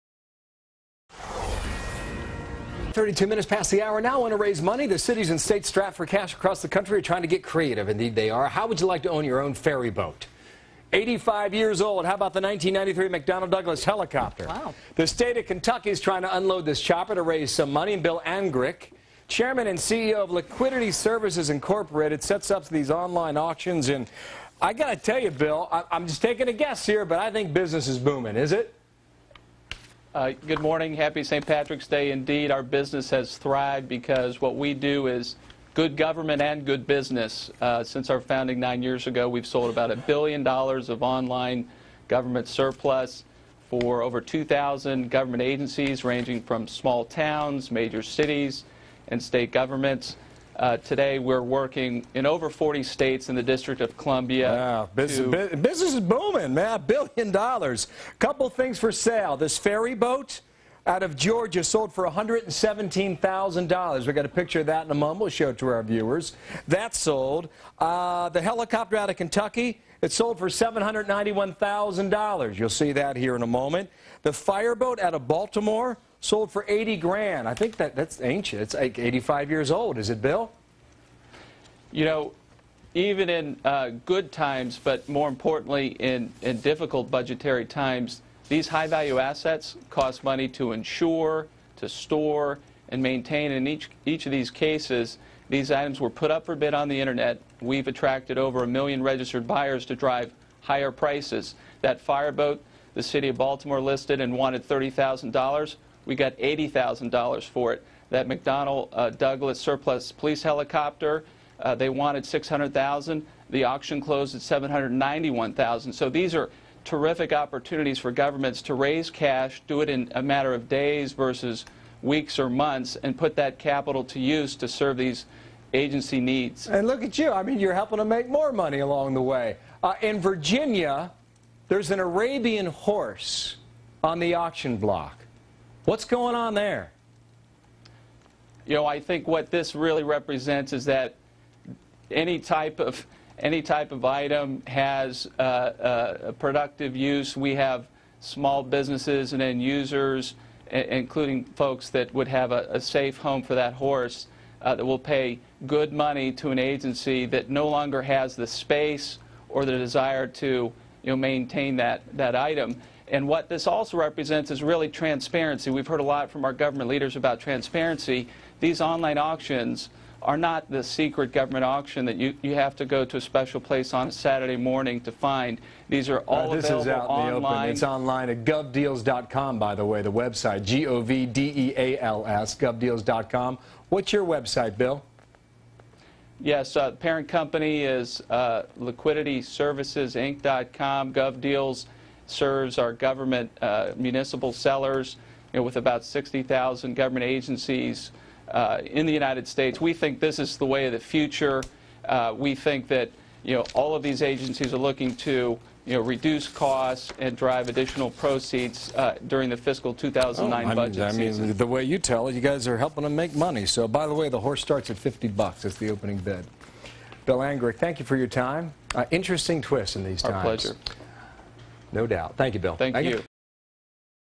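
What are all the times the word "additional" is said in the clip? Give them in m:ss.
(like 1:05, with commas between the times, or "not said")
3:27.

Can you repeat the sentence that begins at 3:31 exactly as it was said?
mean, the way you tell it, you guys are helping them make money.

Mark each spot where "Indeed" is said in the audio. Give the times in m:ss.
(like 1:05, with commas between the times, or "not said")
0:07, 0:32.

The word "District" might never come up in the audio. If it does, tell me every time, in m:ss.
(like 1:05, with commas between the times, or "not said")
0:53.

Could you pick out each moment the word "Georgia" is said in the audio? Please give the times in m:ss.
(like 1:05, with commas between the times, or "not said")
1:01.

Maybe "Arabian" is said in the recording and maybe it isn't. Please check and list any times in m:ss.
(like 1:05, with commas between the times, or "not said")
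2:11.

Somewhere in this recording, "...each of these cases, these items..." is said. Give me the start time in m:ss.
1:34.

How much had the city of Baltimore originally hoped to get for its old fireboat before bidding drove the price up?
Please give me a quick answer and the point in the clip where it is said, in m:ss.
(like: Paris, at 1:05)
$30,000, at 1:44.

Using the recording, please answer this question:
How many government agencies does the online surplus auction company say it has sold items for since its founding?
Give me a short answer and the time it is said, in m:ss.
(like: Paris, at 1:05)
over 2,000, at 0:44.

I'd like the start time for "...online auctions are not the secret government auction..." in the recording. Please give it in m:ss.
2:48.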